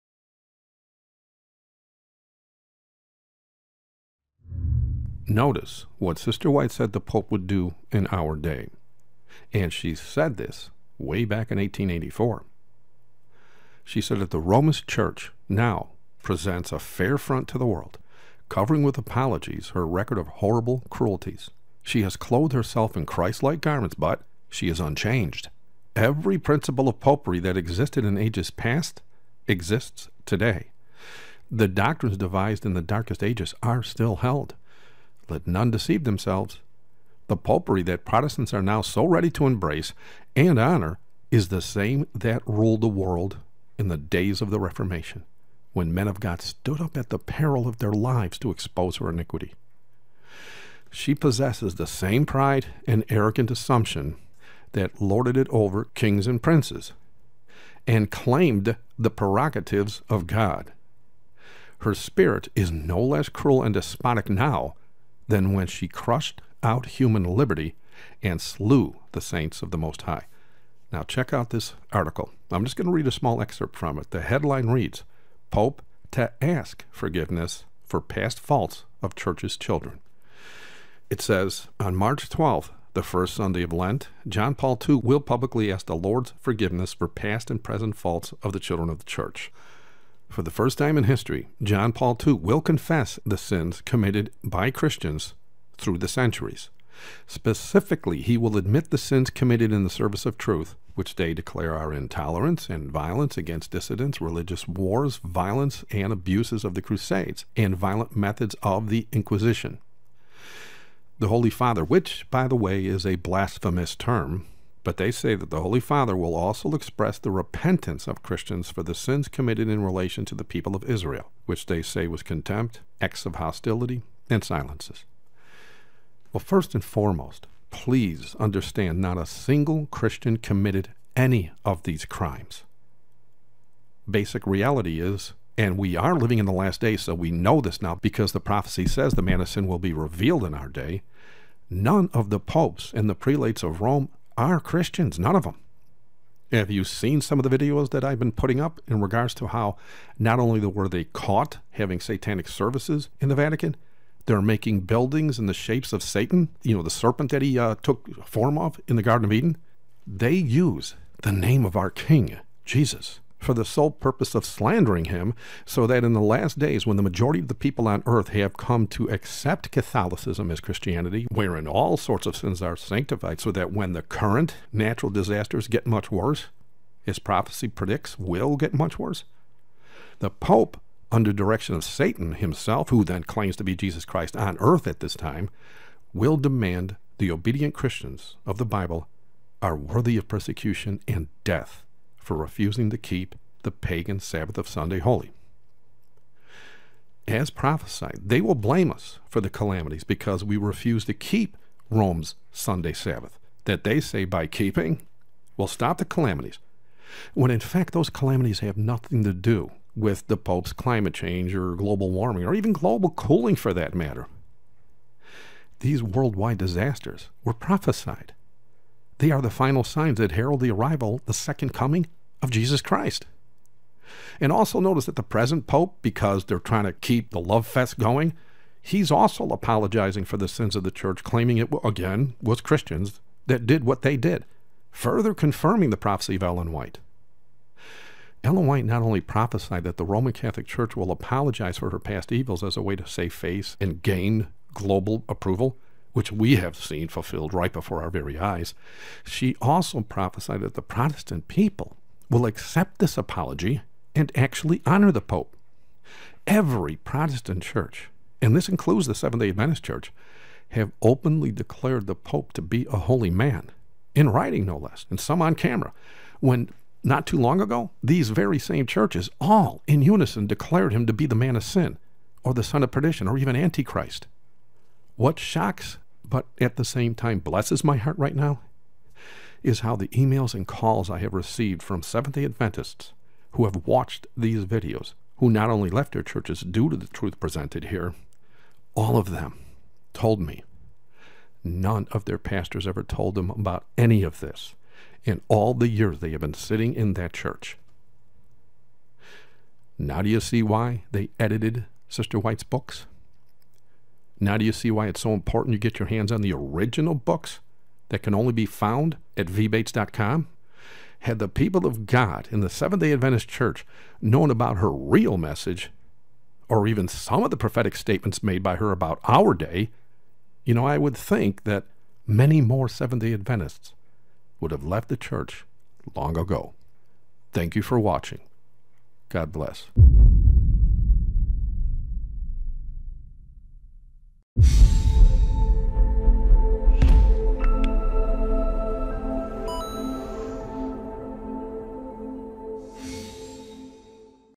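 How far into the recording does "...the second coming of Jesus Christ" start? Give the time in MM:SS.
03:41.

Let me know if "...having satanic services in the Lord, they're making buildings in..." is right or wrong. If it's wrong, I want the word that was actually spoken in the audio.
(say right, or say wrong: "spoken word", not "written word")
wrong: "Vatican", not "Lord".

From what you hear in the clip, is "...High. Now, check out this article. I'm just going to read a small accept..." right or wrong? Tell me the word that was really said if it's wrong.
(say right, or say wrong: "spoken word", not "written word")
wrong: "excerpt", not "accept".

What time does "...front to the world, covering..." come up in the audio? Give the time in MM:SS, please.
00:17.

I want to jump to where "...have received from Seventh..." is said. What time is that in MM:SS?
04:41.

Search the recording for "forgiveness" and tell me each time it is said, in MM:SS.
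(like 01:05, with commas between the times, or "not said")
01:16, 01:26.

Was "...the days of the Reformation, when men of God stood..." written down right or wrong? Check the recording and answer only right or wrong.
right.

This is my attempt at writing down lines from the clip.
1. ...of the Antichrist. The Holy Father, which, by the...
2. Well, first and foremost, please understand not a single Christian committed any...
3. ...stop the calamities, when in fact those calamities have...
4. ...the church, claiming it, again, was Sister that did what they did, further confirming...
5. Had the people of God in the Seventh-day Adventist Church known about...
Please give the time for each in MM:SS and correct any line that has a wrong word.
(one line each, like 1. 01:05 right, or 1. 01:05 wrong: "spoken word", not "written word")
1. 01:48 wrong: "Inquisition", not "Antichrist"
2. 02:06 right
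3. 03:25 right
4. 03:50 wrong: "Christians", not "Sister"
5. 05:11 right.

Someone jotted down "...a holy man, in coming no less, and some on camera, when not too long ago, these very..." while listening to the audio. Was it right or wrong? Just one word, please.
wrong.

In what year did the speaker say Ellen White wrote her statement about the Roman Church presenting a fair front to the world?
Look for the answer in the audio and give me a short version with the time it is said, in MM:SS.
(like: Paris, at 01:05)
1884, at 00:11.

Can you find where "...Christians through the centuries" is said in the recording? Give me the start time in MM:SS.
01:34.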